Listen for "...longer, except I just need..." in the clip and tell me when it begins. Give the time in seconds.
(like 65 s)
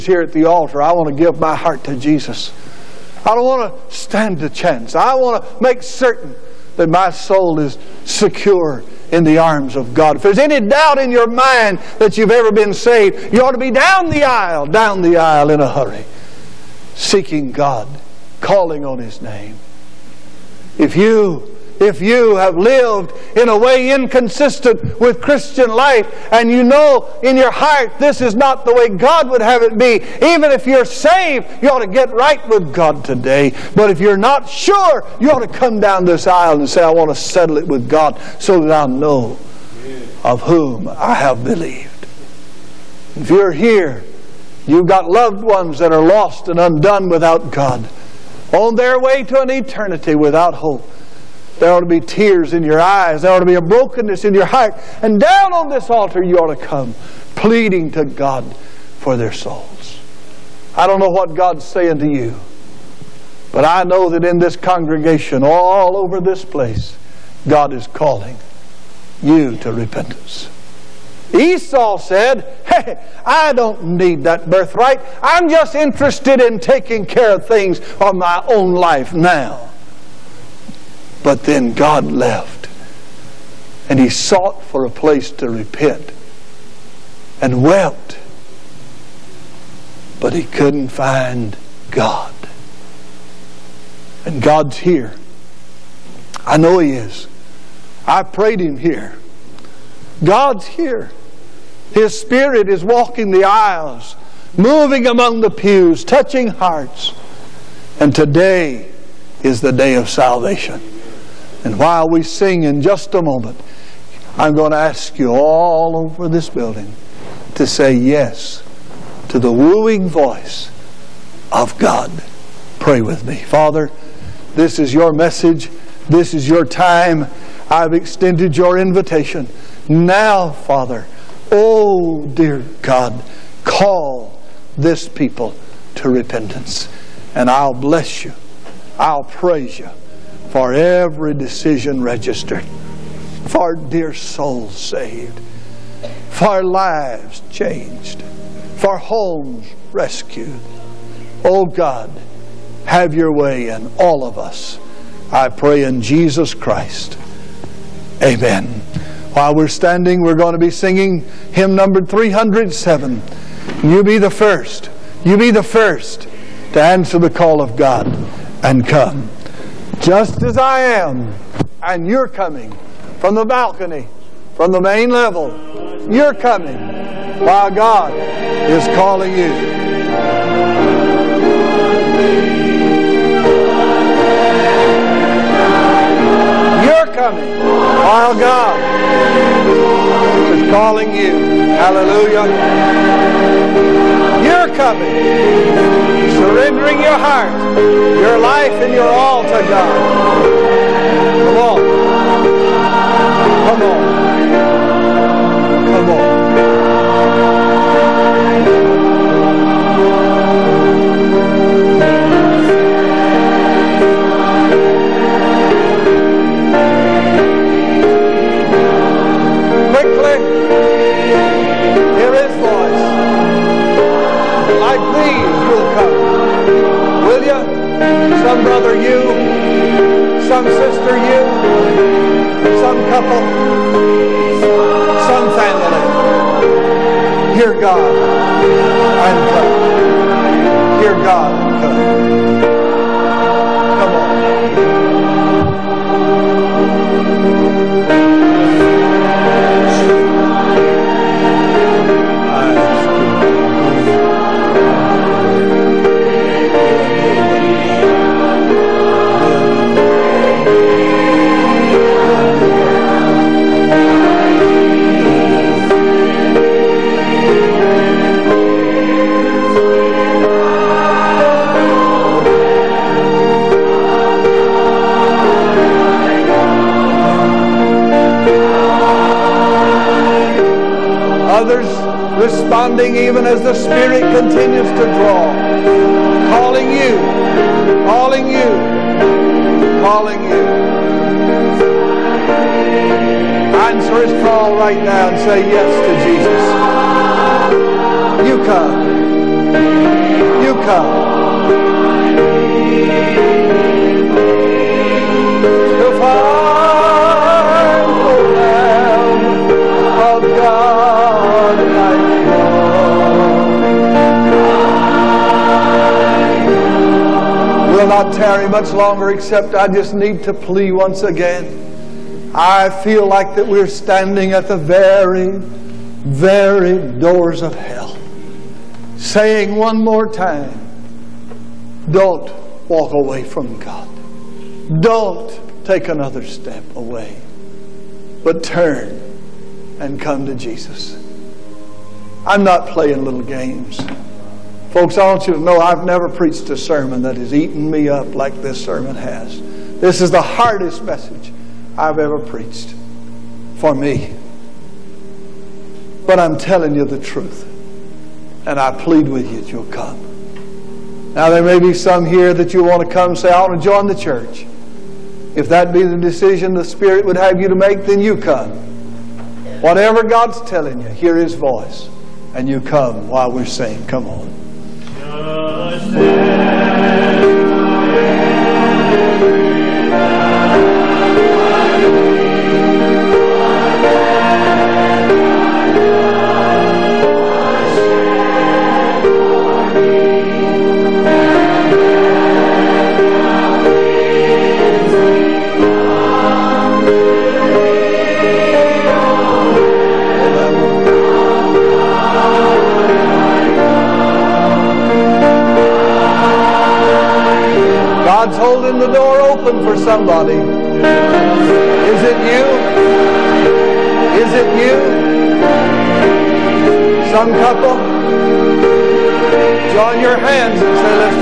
318 s.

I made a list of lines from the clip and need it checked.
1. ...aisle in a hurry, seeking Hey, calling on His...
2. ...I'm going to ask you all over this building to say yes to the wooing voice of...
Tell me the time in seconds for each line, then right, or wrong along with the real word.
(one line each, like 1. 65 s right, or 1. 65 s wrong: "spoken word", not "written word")
1. 15 s wrong: "God", not "Hey"
2. 114 s right.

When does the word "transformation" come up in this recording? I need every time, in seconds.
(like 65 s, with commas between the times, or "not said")
not said.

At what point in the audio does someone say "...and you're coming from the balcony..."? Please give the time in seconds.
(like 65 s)
171 s.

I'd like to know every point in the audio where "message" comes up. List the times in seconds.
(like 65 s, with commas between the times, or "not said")
125 s, 351 s.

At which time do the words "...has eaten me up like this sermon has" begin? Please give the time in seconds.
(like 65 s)
347 s.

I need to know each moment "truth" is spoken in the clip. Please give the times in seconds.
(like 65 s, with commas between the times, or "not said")
357 s.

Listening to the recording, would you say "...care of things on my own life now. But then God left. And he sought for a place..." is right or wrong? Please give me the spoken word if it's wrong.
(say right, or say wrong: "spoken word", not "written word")
right.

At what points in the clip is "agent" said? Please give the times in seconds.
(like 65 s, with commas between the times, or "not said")
not said.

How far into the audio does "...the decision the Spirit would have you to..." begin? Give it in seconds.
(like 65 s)
366 s.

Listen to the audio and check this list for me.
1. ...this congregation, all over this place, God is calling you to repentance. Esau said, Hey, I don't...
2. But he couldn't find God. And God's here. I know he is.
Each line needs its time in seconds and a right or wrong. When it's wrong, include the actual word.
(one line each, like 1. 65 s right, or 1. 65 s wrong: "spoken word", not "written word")
1. 64 s right
2. 90 s right.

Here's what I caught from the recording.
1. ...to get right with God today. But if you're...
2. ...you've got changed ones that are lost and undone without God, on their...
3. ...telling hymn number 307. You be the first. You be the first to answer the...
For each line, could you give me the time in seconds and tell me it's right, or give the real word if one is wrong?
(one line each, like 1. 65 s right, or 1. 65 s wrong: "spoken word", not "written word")
1. 31 s right
2. 44 s wrong: "loved", not "changed"
3. 160 s wrong: "singing", not "telling".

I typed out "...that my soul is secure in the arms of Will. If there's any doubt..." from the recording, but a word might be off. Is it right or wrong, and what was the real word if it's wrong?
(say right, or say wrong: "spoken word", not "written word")
wrong: "God", not "Will".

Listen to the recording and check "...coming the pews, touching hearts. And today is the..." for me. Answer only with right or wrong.
wrong.